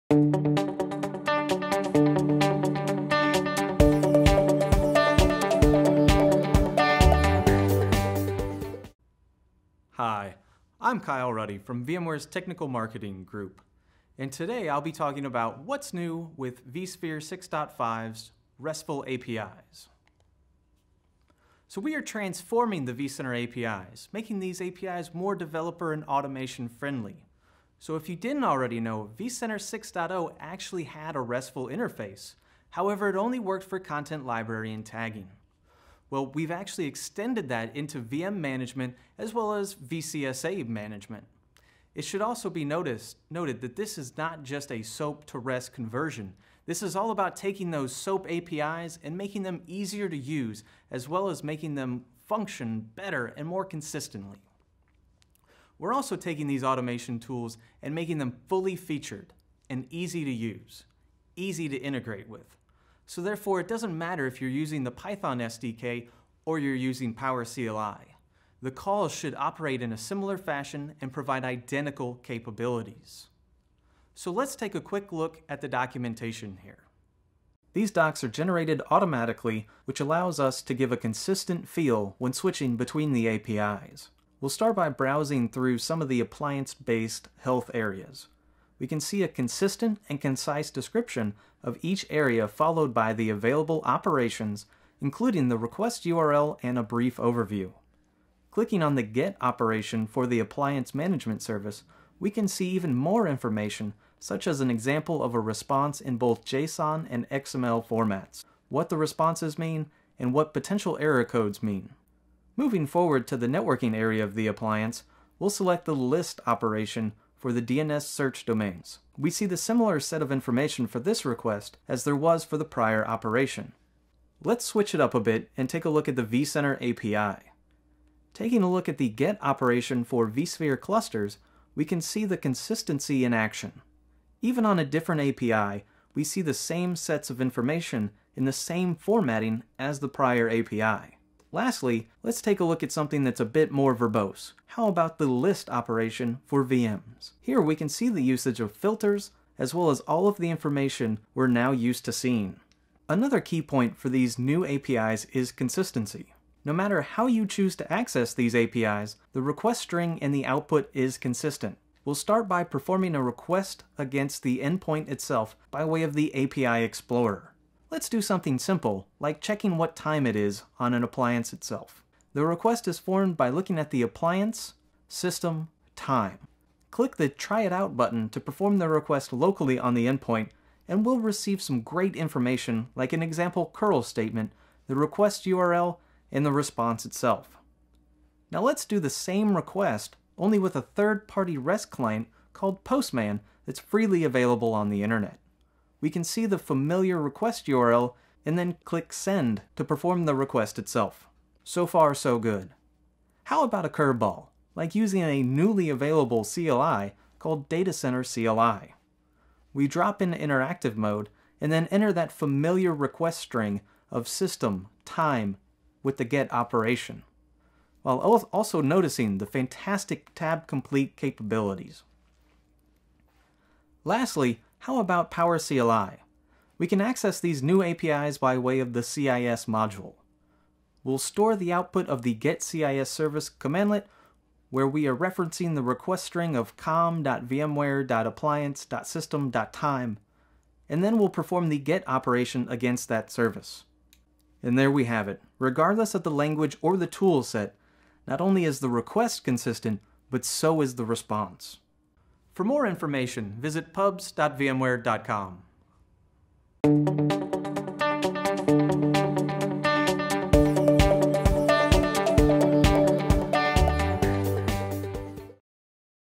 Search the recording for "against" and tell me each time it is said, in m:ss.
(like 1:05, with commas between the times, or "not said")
2:43, 4:02.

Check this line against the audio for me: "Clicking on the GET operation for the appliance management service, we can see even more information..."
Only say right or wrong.
right.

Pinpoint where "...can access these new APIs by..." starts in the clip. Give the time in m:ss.
3:46.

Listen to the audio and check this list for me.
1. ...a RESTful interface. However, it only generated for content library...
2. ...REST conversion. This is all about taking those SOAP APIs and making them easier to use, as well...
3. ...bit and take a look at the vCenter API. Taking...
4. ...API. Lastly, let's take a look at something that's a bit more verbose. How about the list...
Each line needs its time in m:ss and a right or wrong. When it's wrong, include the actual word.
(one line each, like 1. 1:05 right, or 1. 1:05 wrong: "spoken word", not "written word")
1. 0:31 wrong: "worked", not "generated"
2. 0:45 right
3. 2:05 right
4. 2:20 right.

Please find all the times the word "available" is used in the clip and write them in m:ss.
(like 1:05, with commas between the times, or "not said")
1:33, 3:14, 3:25.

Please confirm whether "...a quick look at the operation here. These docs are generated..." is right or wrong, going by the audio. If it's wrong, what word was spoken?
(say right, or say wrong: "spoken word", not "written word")
wrong: "documentation", not "operation".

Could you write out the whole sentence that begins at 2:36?
No matter how you choose to access these APIs, the request string and the output is consistent.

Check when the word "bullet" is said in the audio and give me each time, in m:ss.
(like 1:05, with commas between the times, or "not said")
not said.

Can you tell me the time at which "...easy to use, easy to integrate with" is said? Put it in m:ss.
0:59.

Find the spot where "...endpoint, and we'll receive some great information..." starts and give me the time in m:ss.
3:00.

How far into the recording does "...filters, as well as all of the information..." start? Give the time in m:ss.
2:28.